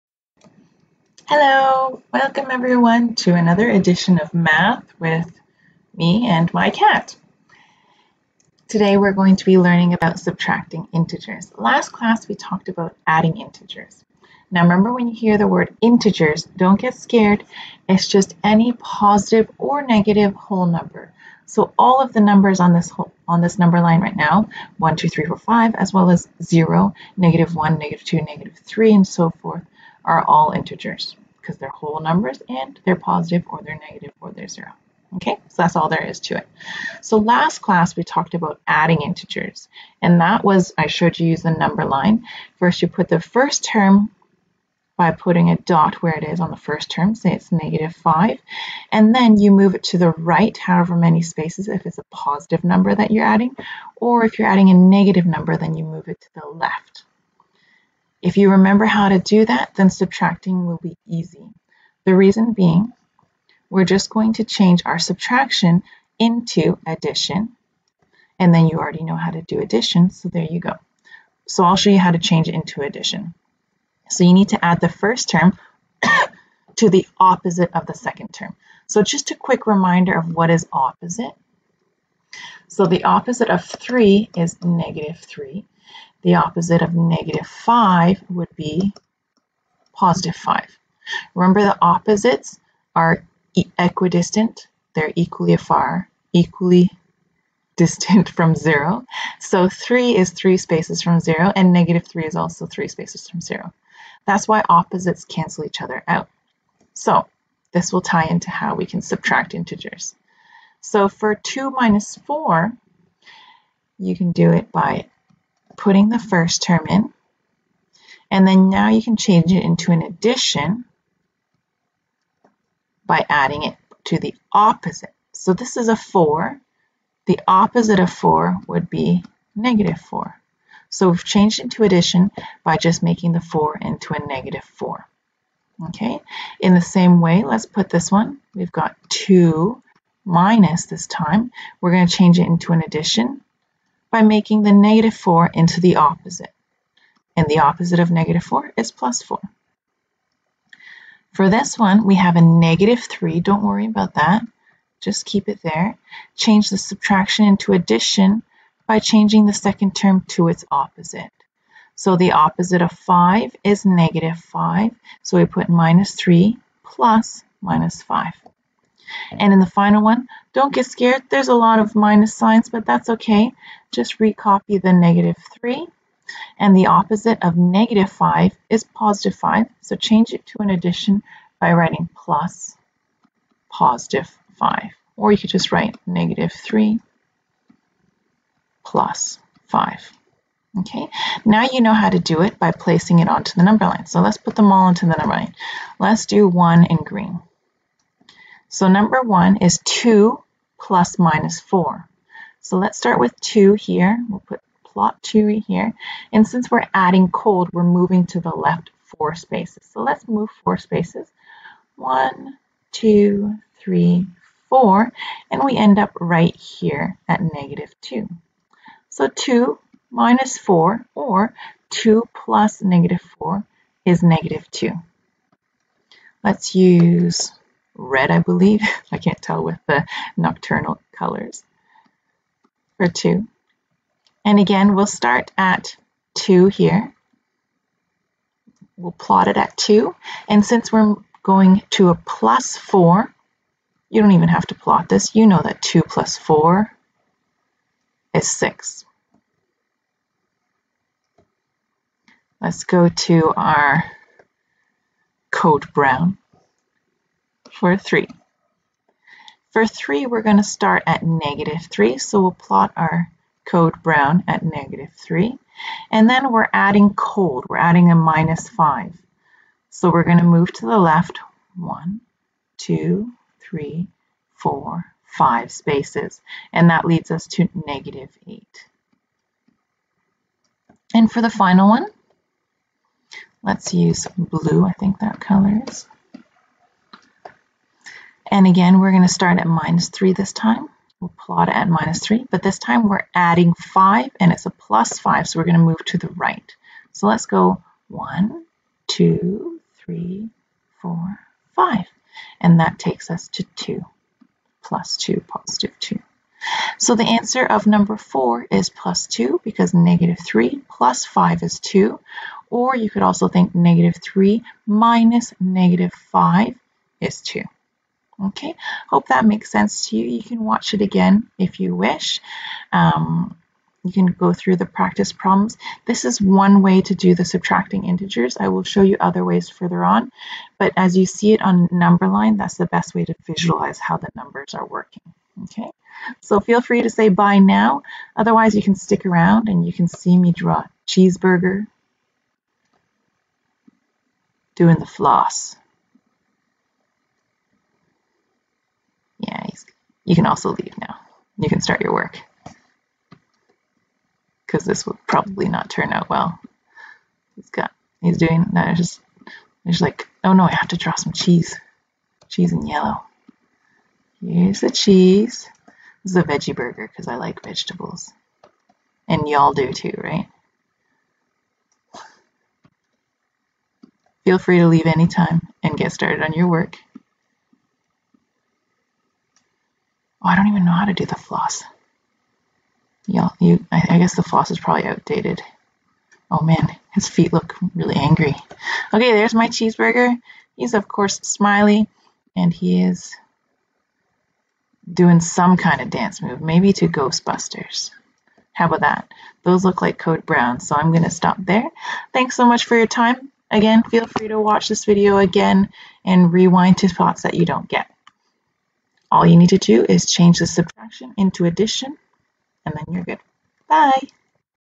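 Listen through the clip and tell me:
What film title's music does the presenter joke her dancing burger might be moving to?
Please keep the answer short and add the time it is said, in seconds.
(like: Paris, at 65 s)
Ghostbusters, at 397 s.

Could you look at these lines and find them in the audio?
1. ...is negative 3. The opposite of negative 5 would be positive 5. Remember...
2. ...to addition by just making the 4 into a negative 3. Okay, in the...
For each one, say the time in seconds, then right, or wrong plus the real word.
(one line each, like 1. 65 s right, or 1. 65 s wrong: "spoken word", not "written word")
1. 84 s right
2. 131 s wrong: "4", not "3".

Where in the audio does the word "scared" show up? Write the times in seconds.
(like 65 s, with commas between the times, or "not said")
16 s, 170 s.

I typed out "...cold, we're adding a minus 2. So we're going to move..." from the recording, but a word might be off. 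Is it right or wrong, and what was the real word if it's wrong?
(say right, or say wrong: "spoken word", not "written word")
wrong: "5", not "2".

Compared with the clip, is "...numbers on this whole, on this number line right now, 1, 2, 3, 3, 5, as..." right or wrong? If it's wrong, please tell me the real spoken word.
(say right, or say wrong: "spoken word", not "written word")
wrong: "4", not "3".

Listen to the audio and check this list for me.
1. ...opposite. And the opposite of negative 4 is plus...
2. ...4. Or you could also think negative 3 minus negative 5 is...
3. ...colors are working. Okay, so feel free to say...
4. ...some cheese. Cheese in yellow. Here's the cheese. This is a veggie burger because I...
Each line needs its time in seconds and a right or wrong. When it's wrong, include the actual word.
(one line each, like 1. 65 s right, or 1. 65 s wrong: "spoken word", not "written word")
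1. 145 s right
2. 311 s wrong: "2", not "4"
3. 334 s wrong: "numbers", not "colors"
4. 361 s right.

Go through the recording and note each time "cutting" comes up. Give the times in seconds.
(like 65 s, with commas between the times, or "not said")
not said.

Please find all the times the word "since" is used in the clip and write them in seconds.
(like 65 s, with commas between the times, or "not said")
206 s, 240 s.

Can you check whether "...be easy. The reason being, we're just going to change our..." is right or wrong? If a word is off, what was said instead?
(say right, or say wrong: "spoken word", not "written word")
right.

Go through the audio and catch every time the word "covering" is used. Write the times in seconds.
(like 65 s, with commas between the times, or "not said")
not said.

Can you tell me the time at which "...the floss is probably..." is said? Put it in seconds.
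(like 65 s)
384 s.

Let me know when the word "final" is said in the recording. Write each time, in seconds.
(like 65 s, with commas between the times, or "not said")
169 s, 281 s.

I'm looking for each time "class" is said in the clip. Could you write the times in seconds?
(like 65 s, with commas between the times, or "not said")
11 s, 37 s.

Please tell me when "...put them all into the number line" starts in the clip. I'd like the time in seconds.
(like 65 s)
194 s.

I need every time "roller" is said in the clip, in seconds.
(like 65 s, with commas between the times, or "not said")
not said.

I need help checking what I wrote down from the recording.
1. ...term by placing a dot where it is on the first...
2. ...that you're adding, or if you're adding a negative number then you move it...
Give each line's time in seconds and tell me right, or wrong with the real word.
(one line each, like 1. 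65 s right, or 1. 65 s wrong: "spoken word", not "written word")
1. 43 s wrong: "putting", not "placing"
2. 52 s right.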